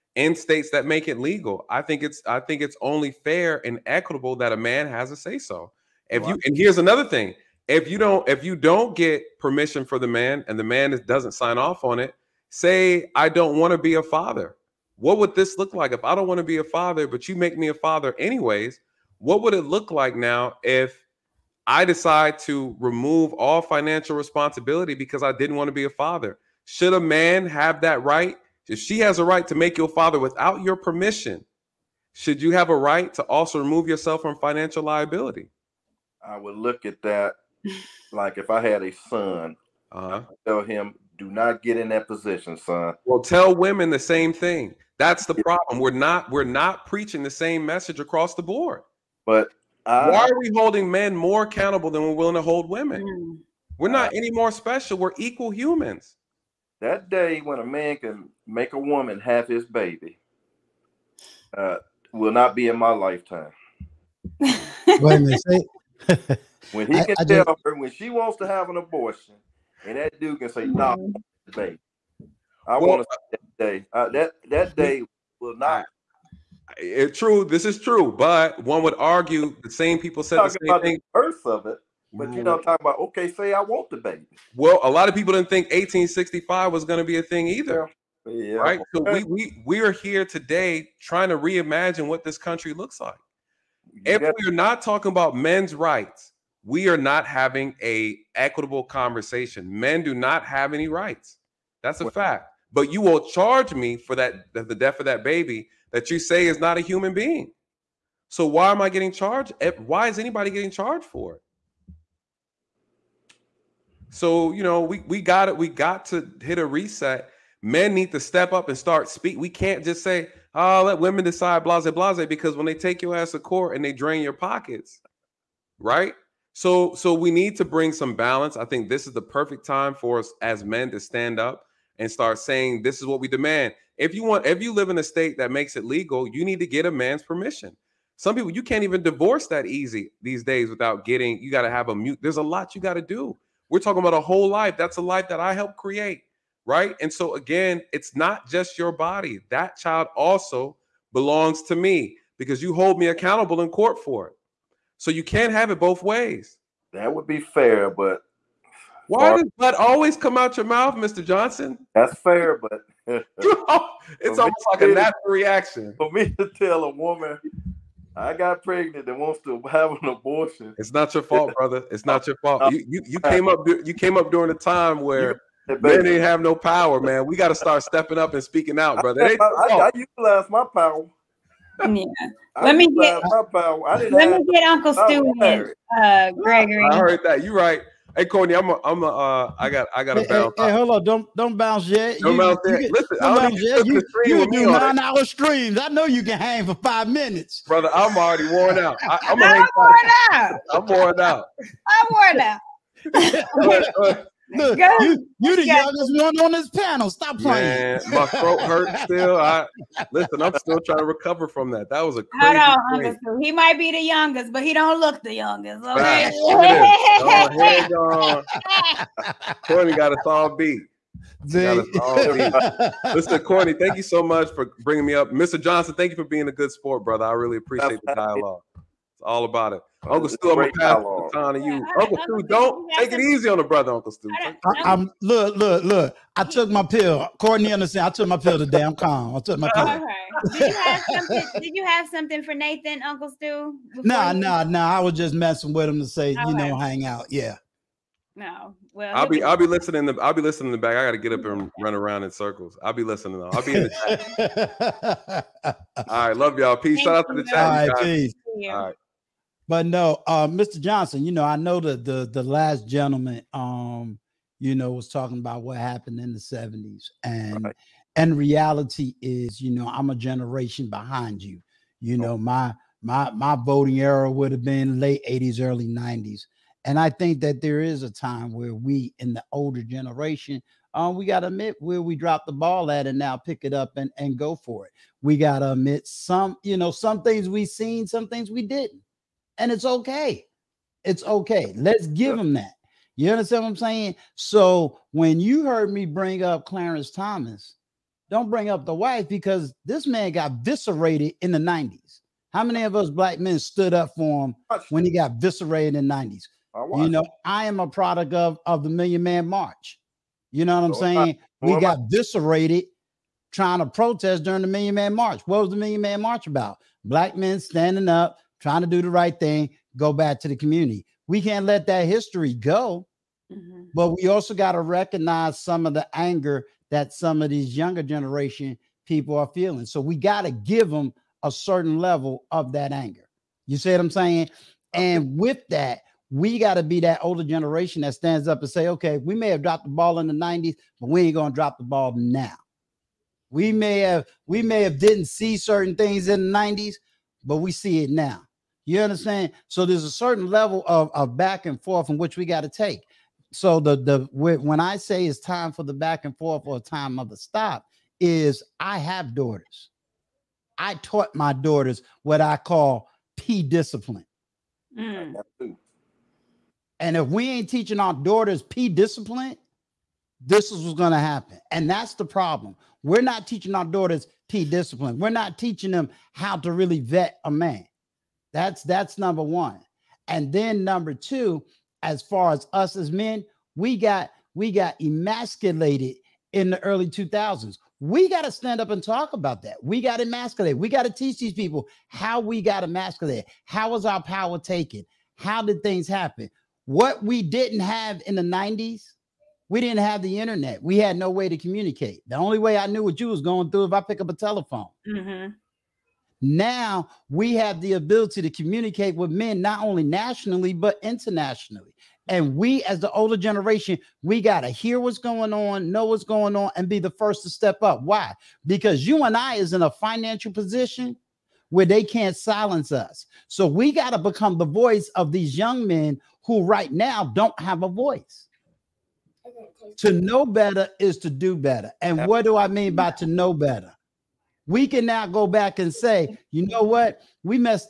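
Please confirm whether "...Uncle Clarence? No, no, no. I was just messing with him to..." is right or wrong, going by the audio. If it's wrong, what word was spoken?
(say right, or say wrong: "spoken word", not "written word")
wrong: "Stu", not "Clarence".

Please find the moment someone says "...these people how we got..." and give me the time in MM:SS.
06:31.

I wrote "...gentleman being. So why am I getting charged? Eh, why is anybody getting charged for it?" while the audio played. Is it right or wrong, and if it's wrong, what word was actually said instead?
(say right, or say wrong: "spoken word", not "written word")
wrong: "human", not "gentleman".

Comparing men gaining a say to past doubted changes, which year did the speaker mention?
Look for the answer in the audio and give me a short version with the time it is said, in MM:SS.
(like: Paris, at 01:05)
1865, at 01:25.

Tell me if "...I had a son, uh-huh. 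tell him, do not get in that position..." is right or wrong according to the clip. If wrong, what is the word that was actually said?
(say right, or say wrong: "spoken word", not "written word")
right.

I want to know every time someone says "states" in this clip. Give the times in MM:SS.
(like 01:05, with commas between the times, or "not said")
00:00, 02:15.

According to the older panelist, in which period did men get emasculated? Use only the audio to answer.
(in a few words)
early 2000s.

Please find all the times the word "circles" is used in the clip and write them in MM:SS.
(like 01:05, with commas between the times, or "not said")
04:12.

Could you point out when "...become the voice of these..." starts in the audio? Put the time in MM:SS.
07:04.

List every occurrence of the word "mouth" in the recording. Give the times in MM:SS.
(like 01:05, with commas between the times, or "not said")
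02:40.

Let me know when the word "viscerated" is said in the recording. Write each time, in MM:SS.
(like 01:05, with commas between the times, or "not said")
05:00, 05:05, 05:12.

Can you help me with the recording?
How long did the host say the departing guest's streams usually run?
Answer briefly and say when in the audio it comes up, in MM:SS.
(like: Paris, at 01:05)
9 hours, at 03:14.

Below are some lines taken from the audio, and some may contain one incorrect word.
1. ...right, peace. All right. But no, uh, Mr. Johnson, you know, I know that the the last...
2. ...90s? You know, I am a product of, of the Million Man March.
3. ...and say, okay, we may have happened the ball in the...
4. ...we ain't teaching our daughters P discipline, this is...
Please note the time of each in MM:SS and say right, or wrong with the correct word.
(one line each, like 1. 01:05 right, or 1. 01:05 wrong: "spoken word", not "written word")
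1. 04:17 right
2. 05:06 right
3. 05:38 wrong: "dropped", not "happened"
4. 06:07 right.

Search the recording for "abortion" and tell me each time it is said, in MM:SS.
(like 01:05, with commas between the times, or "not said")
01:08, 02:50.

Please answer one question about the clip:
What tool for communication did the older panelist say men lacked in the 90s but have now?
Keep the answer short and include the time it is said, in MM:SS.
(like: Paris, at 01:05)
the internet, at 06:40.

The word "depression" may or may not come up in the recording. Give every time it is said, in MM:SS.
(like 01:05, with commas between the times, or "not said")
not said.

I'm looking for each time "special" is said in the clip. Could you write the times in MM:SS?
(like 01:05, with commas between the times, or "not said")
00:54.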